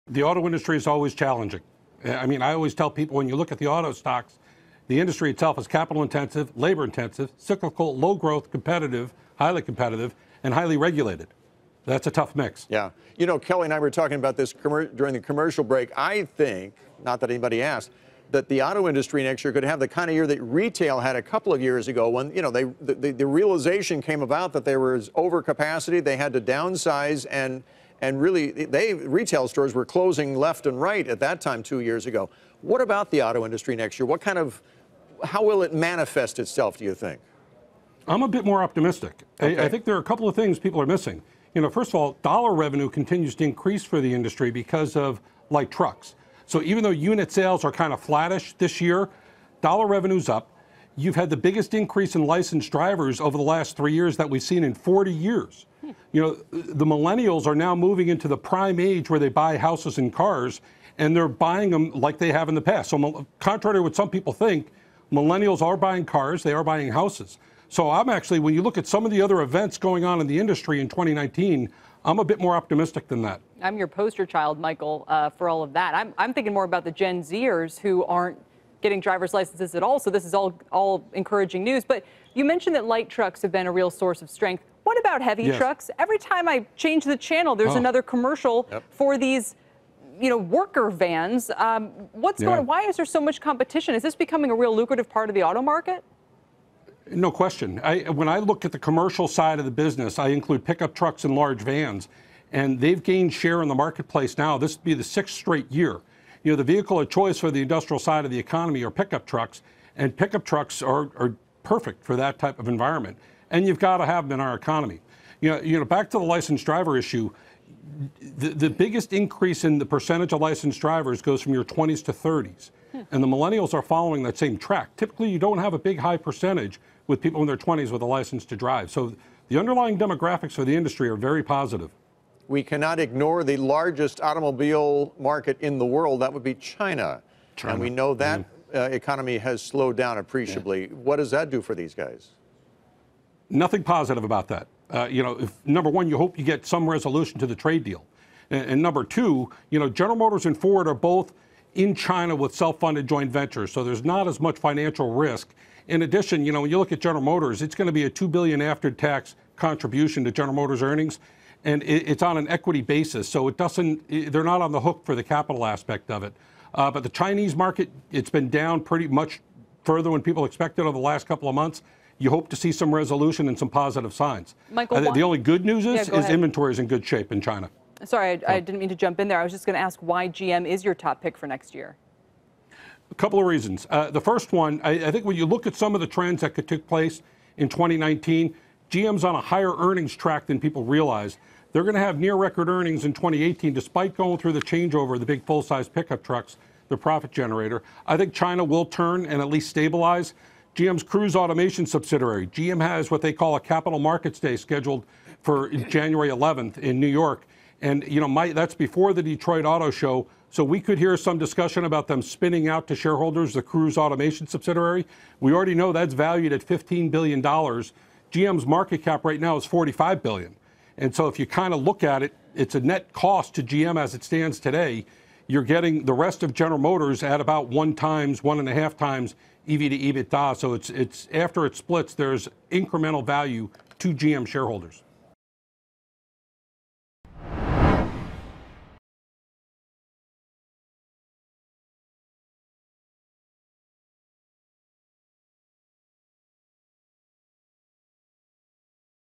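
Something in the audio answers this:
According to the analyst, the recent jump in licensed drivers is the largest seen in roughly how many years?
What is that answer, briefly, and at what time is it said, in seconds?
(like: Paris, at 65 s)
40 years, at 54 s.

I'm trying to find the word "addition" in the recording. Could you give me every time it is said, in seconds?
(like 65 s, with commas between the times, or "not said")
156 s.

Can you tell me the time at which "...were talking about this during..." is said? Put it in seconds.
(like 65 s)
13 s.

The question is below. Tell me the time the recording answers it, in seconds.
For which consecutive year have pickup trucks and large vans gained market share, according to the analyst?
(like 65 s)
105 s.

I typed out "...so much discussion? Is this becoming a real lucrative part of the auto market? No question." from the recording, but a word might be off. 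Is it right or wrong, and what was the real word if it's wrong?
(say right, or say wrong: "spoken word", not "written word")
wrong: "competition", not "discussion".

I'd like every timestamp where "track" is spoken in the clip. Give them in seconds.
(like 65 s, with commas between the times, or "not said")
124 s, 190 s.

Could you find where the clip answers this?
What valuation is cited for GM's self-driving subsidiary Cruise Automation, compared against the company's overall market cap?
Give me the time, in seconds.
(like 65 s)
216 s.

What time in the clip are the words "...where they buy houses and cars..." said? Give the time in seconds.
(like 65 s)
59 s.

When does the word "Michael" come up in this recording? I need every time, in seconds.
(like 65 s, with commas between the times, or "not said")
74 s, 174 s.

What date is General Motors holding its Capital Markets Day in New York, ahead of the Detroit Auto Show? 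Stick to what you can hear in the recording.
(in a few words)
January 11th.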